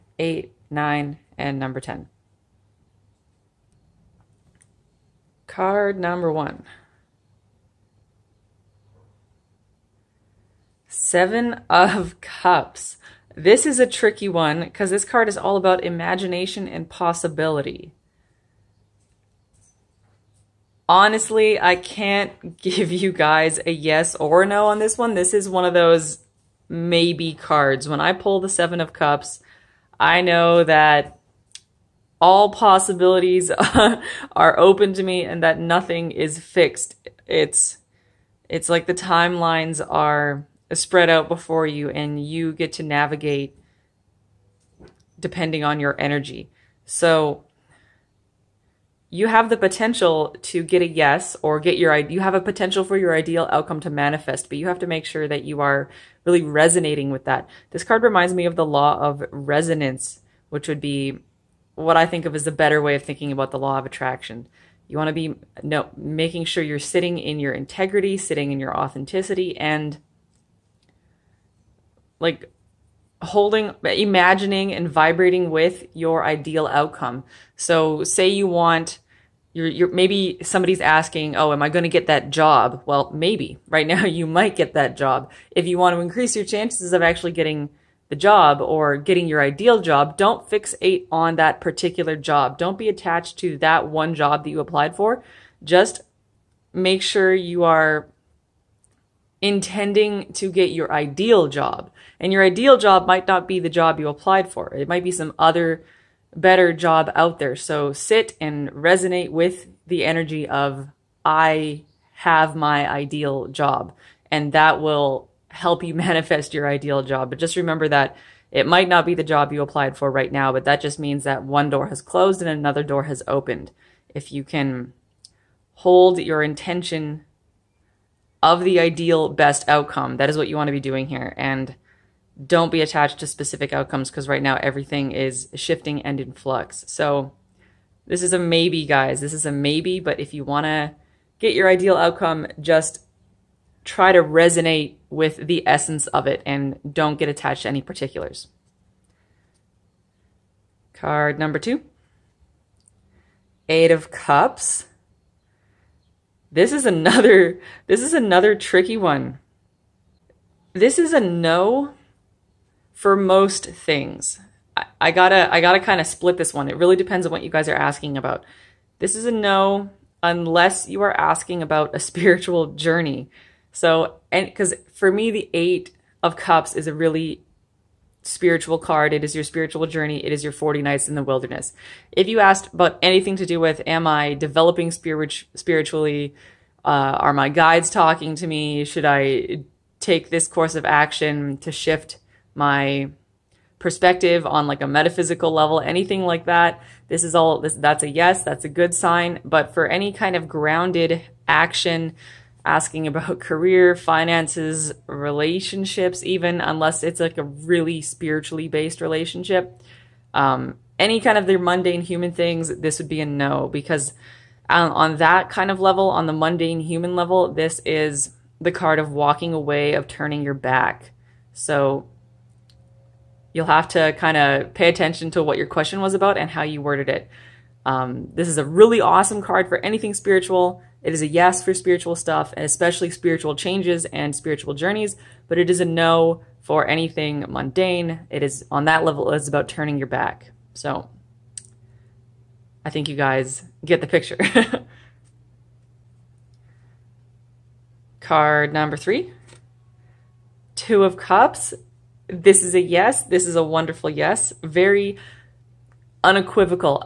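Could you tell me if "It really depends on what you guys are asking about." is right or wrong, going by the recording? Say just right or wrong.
right.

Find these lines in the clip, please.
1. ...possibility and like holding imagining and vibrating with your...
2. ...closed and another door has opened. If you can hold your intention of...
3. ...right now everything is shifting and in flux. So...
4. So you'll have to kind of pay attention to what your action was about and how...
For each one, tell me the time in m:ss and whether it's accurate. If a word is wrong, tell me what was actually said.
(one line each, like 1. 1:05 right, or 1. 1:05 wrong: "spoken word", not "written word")
1. 1:08 wrong: "authenticity", not "possibility"
2. 2:02 right
3. 2:14 right
4. 3:41 wrong: "question", not "action".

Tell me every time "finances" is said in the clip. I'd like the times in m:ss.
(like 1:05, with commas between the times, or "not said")
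3:23.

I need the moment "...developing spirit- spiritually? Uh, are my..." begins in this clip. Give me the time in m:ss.
3:04.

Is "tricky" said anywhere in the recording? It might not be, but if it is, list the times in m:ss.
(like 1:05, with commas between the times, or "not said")
0:13, 2:38.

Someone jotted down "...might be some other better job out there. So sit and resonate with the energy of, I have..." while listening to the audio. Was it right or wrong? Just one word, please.
right.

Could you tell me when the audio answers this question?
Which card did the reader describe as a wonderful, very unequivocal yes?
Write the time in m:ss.
4:10.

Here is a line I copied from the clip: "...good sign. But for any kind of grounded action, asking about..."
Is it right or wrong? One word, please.
right.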